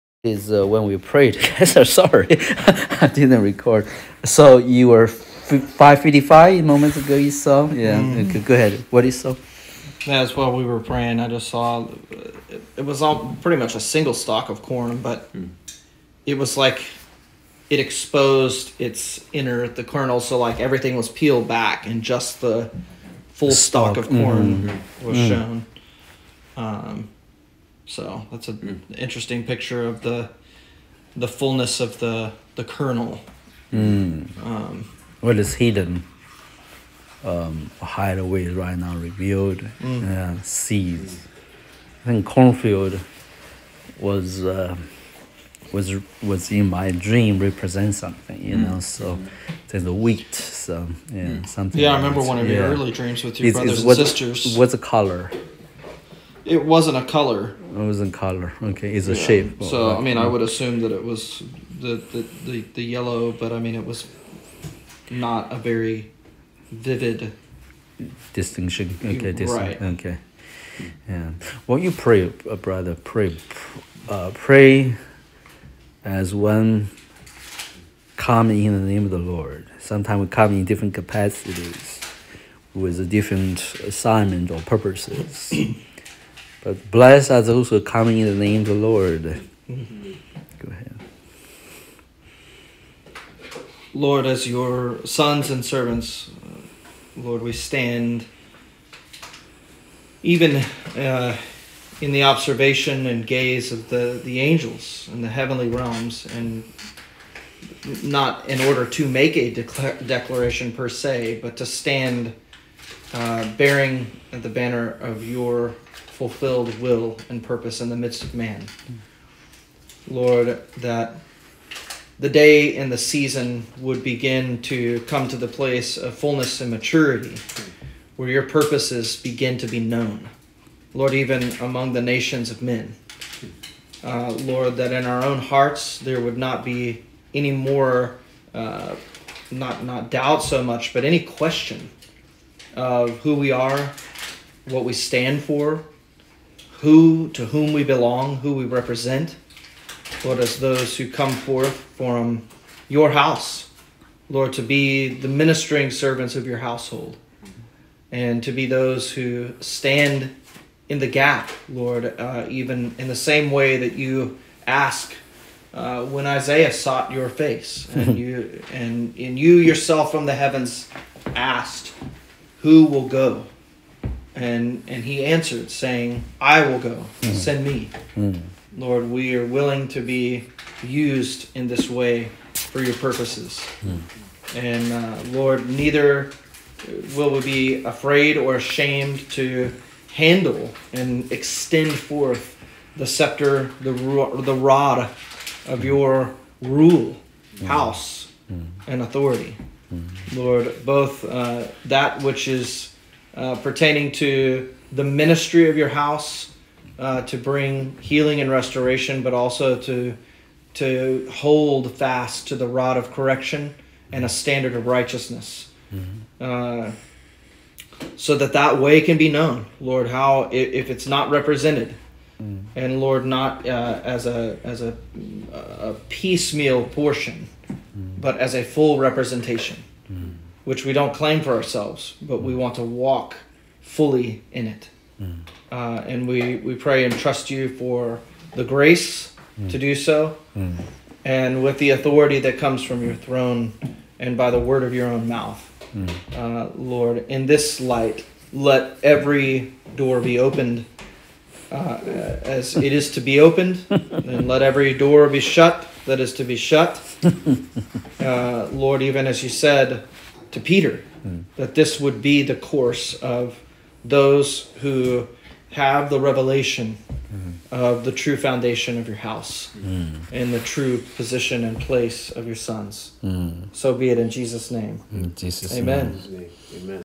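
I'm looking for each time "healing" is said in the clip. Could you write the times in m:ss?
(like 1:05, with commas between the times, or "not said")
3:27.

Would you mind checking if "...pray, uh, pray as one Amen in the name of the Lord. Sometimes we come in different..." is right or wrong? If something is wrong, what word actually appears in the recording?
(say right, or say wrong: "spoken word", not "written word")
wrong: "Come", not "Amen".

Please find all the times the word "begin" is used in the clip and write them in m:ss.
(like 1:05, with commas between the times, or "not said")
2:04, 2:09.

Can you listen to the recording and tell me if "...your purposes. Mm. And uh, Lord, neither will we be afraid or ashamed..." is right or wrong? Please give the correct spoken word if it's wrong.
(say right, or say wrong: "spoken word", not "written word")
right.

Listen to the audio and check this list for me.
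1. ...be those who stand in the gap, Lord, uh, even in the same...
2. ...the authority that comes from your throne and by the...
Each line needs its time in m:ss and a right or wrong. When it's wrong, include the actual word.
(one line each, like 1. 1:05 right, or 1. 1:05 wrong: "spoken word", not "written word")
1. 2:38 right
2. 4:01 right.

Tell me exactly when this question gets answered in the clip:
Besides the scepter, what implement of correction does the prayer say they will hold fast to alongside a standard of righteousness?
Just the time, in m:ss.
3:32.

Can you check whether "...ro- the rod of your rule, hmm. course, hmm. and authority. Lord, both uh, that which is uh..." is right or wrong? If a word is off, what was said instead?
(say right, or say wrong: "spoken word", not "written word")
wrong: "house", not "course".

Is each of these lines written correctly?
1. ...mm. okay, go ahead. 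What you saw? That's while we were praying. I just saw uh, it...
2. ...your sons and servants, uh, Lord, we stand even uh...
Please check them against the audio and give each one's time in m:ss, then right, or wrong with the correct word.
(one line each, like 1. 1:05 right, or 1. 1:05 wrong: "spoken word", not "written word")
1. 0:07 right
2. 1:34 right.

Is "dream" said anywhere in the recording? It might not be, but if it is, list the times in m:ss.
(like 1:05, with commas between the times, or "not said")
0:46, 0:52.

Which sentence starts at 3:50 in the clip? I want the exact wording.
which we don't claim for ourselves, but we hmm.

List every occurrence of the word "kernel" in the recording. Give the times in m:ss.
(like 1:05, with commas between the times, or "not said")
0:19, 0:32.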